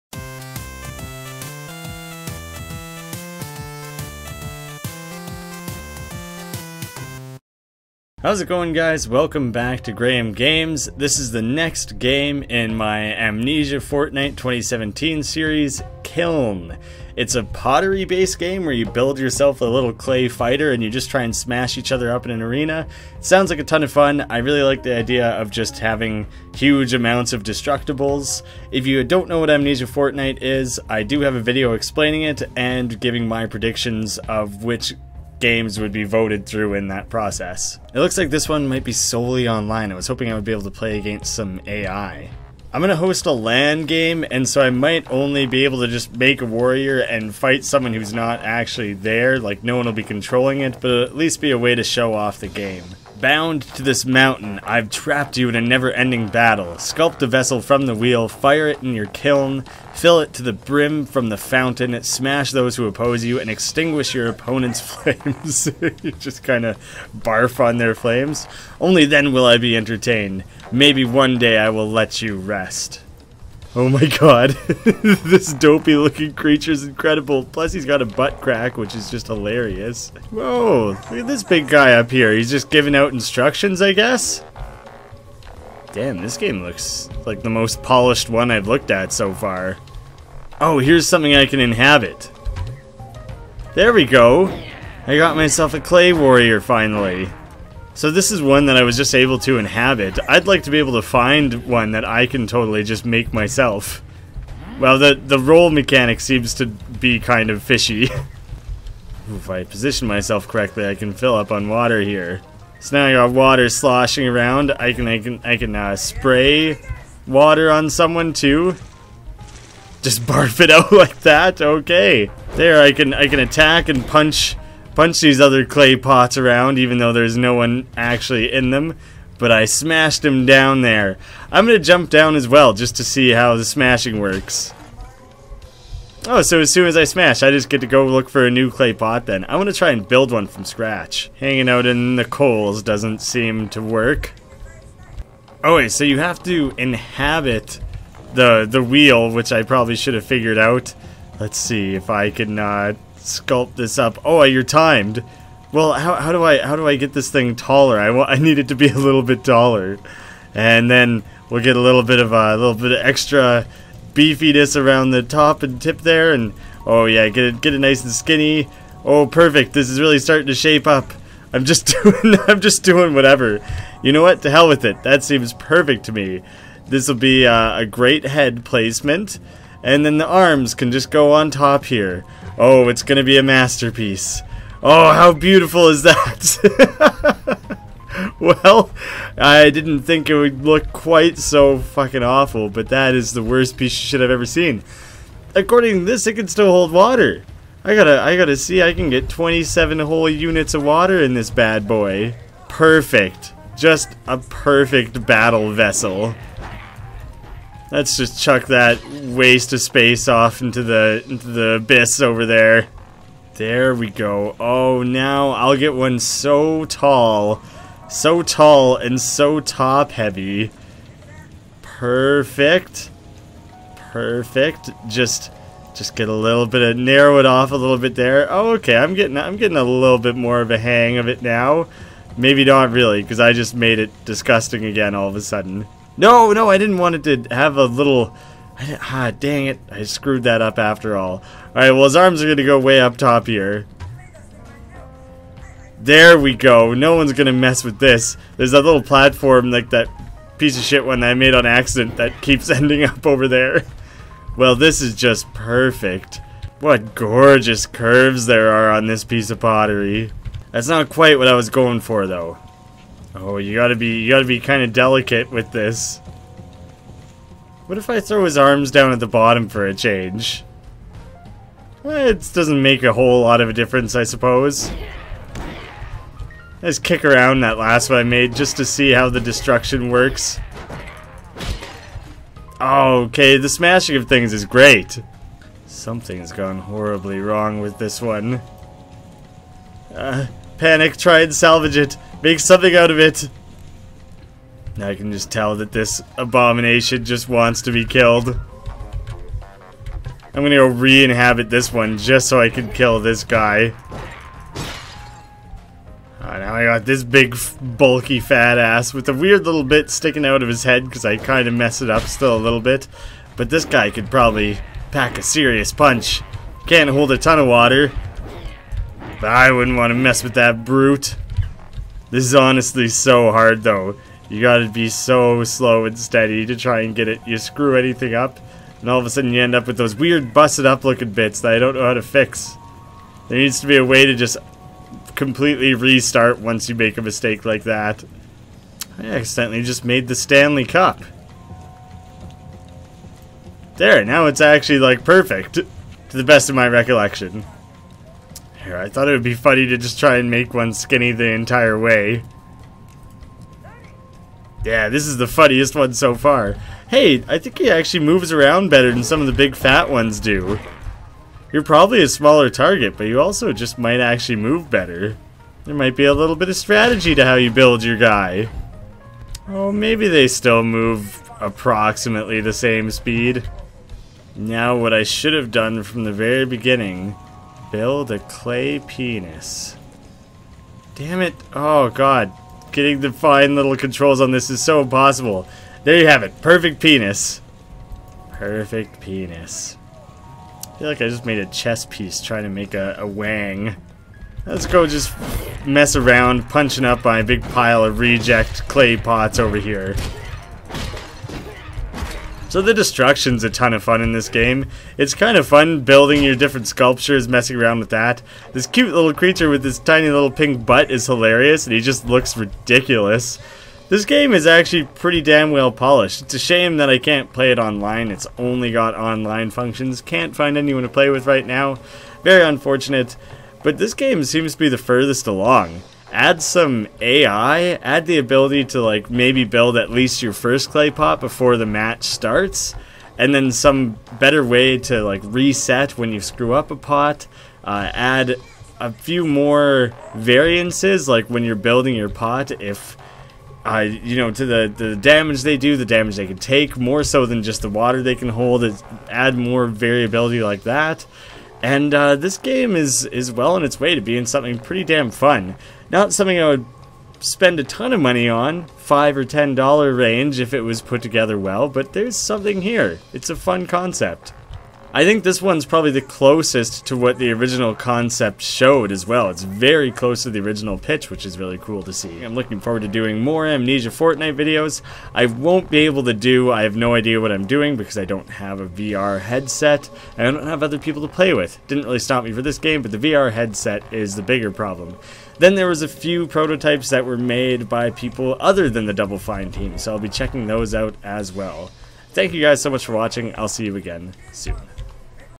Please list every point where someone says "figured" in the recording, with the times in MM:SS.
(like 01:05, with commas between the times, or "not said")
02:30.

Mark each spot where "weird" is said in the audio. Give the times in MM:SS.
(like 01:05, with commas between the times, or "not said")
05:09, 05:30.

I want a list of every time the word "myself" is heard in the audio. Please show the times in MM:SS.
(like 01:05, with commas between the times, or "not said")
01:35, 01:43, 01:50.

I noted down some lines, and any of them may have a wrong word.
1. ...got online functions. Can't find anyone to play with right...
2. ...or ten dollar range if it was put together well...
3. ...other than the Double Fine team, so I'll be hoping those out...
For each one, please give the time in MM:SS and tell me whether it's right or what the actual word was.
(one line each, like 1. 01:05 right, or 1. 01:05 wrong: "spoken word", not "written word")
1. 06:58 right
2. 07:39 right
3. 08:08 wrong: "checking", not "hoping".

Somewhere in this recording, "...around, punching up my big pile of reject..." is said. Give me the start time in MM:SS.
06:36.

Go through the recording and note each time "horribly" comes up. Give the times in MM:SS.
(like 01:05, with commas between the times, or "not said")
04:46.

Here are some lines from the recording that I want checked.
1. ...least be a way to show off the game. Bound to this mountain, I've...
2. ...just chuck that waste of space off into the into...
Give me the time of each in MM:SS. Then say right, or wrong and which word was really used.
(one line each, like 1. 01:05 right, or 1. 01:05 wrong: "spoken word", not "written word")
1. 00:51 right
2. 03:28 right.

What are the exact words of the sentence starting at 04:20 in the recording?
That's not quite what I was going for, though.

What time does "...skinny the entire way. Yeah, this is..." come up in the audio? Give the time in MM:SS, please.
05:50.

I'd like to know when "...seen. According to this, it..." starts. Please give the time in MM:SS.
03:14.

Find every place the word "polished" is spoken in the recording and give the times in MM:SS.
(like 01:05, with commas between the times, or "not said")
01:27, 06:55.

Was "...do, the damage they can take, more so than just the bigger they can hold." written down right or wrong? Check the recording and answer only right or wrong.
wrong.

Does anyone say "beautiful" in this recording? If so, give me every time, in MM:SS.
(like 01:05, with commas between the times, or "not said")
03:05.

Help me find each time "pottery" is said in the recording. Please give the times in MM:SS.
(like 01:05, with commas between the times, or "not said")
00:17, 04:19.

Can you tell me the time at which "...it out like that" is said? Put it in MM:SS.
02:00.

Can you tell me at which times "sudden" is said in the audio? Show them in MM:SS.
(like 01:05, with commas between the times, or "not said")
03:55, 05:29.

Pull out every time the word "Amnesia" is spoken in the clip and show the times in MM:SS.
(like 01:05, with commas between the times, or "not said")
00:13, 00:29, 07:53.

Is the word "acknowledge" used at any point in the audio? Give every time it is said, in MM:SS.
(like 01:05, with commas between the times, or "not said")
not said.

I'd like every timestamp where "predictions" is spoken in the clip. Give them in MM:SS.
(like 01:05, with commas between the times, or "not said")
00:33.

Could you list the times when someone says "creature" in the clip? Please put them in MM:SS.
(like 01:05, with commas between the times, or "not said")
01:16, 06:49.